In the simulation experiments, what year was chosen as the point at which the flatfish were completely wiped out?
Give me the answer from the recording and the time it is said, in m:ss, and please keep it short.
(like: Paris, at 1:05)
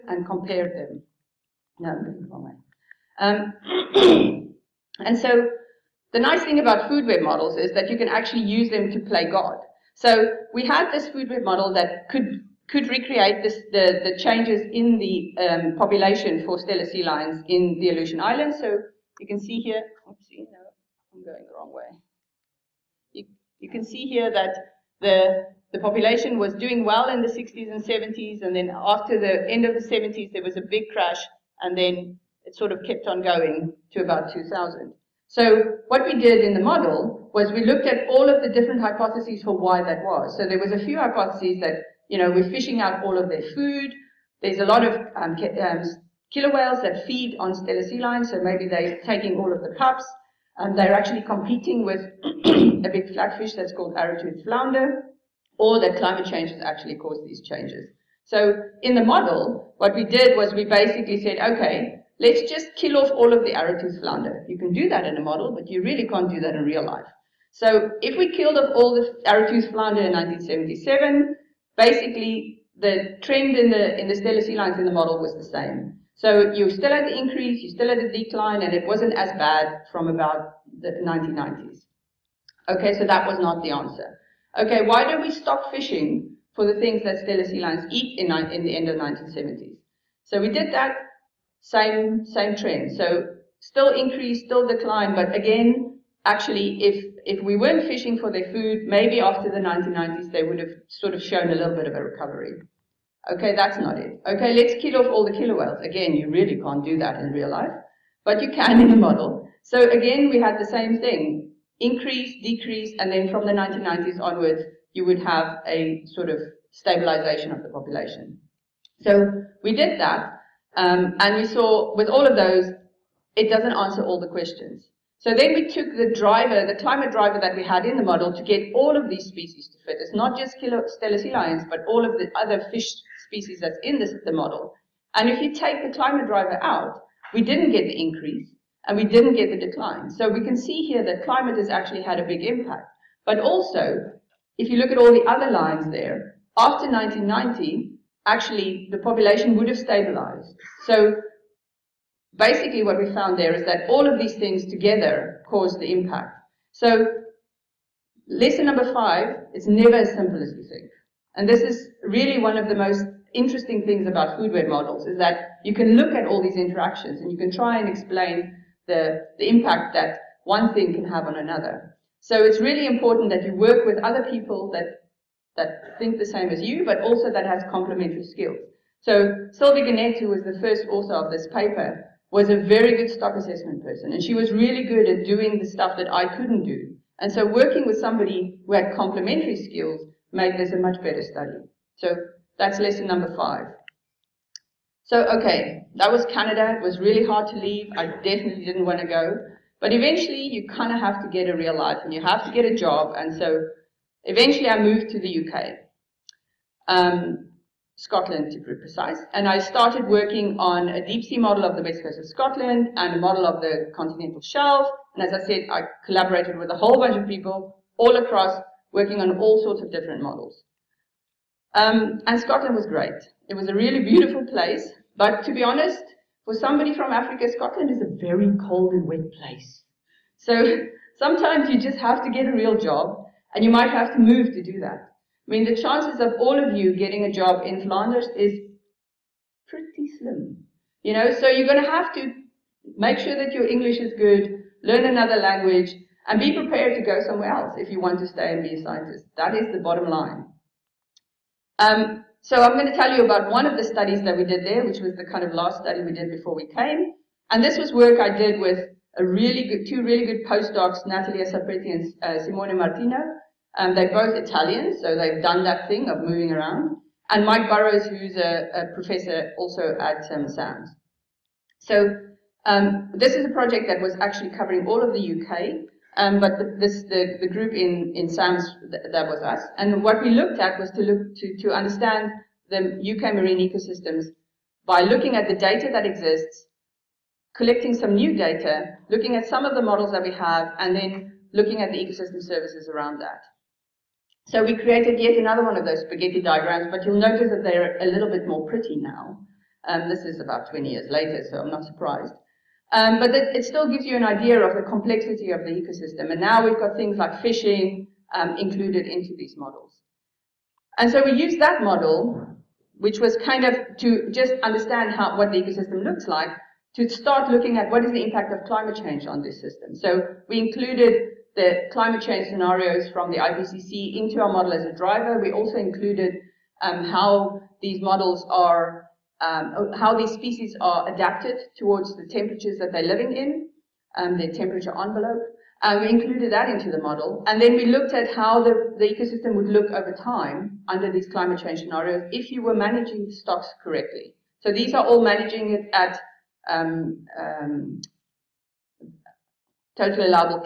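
1977, at 1:10.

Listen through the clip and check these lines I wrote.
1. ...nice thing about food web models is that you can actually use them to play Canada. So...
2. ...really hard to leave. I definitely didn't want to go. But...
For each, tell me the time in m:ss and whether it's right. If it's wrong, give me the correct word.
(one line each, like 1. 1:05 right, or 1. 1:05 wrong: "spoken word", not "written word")
1. 0:06 wrong: "God", not "Canada"
2. 3:16 right.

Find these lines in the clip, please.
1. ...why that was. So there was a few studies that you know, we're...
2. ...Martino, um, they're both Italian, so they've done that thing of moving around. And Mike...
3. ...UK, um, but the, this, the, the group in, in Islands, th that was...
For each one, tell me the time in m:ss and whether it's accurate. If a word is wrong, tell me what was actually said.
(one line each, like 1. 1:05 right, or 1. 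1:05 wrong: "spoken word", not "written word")
1. 0:39 wrong: "hypotheses", not "studies"
2. 4:22 right
3. 4:35 wrong: "SAMS", not "Islands".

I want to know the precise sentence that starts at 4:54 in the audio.
So we created yet another one of those spaghetti diagrams, but you'll notice that they're a little bit more pretty now.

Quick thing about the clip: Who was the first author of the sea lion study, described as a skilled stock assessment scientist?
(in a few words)
Sylvie Guénette.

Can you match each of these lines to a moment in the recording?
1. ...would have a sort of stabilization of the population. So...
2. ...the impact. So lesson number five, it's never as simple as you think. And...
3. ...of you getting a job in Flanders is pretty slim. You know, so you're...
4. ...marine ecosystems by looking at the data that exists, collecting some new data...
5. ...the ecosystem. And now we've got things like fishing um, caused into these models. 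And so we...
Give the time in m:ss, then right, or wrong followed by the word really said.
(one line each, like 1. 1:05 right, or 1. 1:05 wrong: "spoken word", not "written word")
1. 1:55 right
2. 2:35 right
3. 3:56 right
4. 4:43 right
5. 5:05 wrong: "included", not "caused".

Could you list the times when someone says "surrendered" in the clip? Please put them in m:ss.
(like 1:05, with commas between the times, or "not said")
not said.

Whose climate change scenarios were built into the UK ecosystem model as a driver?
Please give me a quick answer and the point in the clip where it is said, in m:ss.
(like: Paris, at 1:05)
IPCC, at 5:23.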